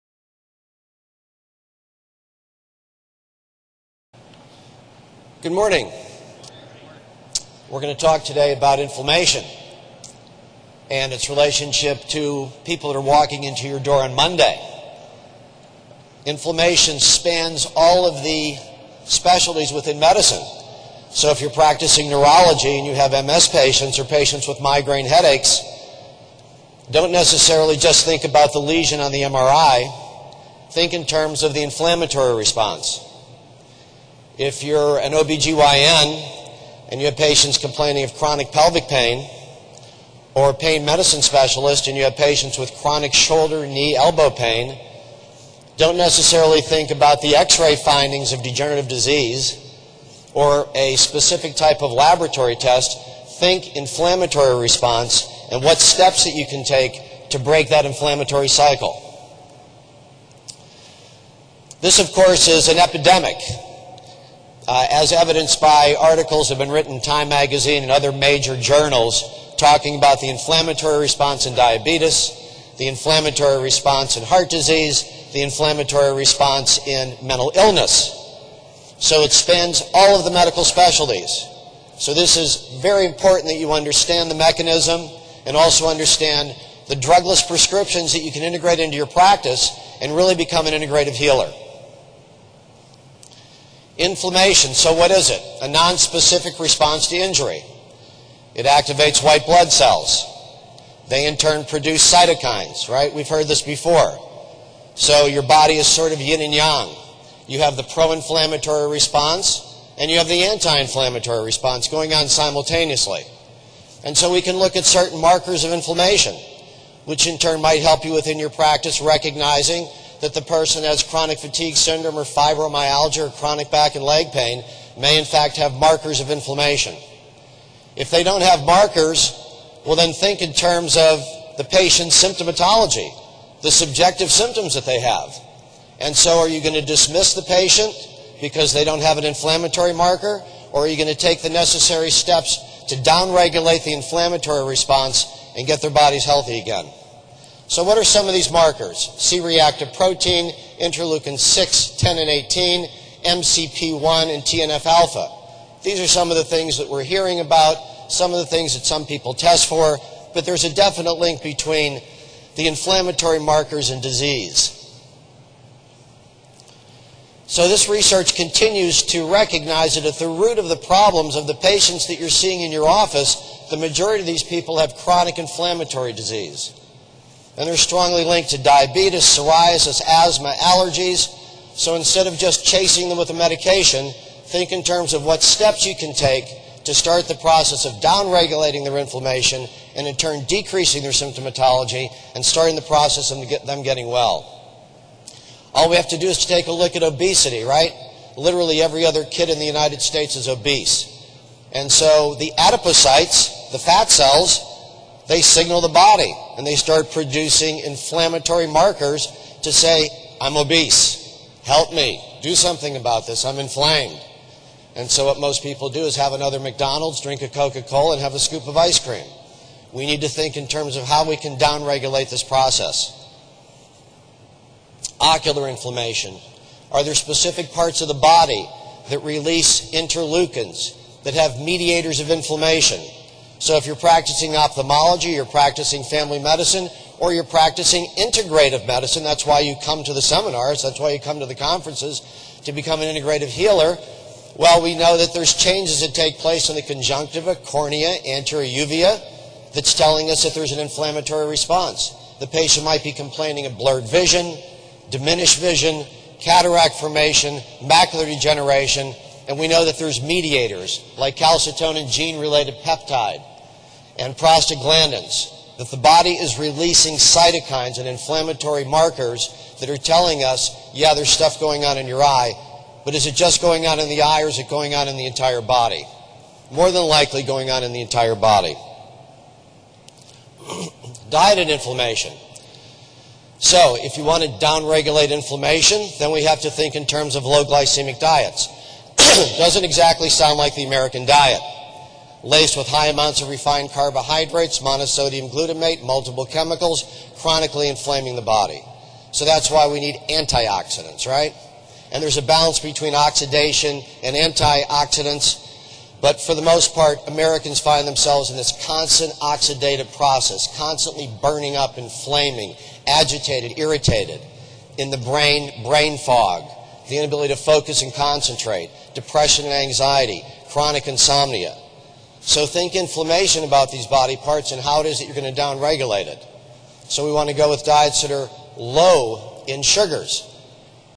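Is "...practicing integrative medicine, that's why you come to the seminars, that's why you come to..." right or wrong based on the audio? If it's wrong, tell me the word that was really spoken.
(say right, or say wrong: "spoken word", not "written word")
right.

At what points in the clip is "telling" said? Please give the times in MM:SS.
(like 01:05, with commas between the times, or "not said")
04:09, 04:29.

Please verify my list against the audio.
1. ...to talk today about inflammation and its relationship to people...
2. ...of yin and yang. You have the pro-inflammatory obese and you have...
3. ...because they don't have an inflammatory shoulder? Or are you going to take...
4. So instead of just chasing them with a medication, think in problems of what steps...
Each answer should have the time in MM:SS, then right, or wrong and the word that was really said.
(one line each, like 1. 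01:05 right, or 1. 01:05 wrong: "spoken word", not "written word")
1. 00:07 right
2. 01:46 wrong: "response", not "obese"
3. 02:18 wrong: "marker", not "shoulder"
4. 03:01 wrong: "terms", not "problems".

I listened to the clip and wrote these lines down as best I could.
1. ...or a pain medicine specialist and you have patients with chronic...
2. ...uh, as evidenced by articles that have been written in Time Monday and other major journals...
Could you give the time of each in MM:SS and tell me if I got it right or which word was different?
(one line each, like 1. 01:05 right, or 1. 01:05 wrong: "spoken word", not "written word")
1. 00:40 right
2. 01:04 wrong: "Magazine", not "Monday".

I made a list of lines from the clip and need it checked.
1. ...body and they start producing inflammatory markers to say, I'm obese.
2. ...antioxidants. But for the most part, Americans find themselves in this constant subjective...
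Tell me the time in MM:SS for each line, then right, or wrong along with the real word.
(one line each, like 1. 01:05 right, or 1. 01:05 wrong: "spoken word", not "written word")
1. 03:25 right
2. 05:04 wrong: "oxidative", not "subjective".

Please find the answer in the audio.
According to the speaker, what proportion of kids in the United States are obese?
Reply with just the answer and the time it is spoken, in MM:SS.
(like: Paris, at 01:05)
Every other kid, at 03:18.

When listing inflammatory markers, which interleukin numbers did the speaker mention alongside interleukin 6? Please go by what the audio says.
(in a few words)
10 and 18.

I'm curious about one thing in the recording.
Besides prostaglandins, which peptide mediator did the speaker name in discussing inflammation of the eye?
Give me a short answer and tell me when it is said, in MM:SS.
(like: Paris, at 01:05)
Calcitonin gene-related peptide, at 04:21.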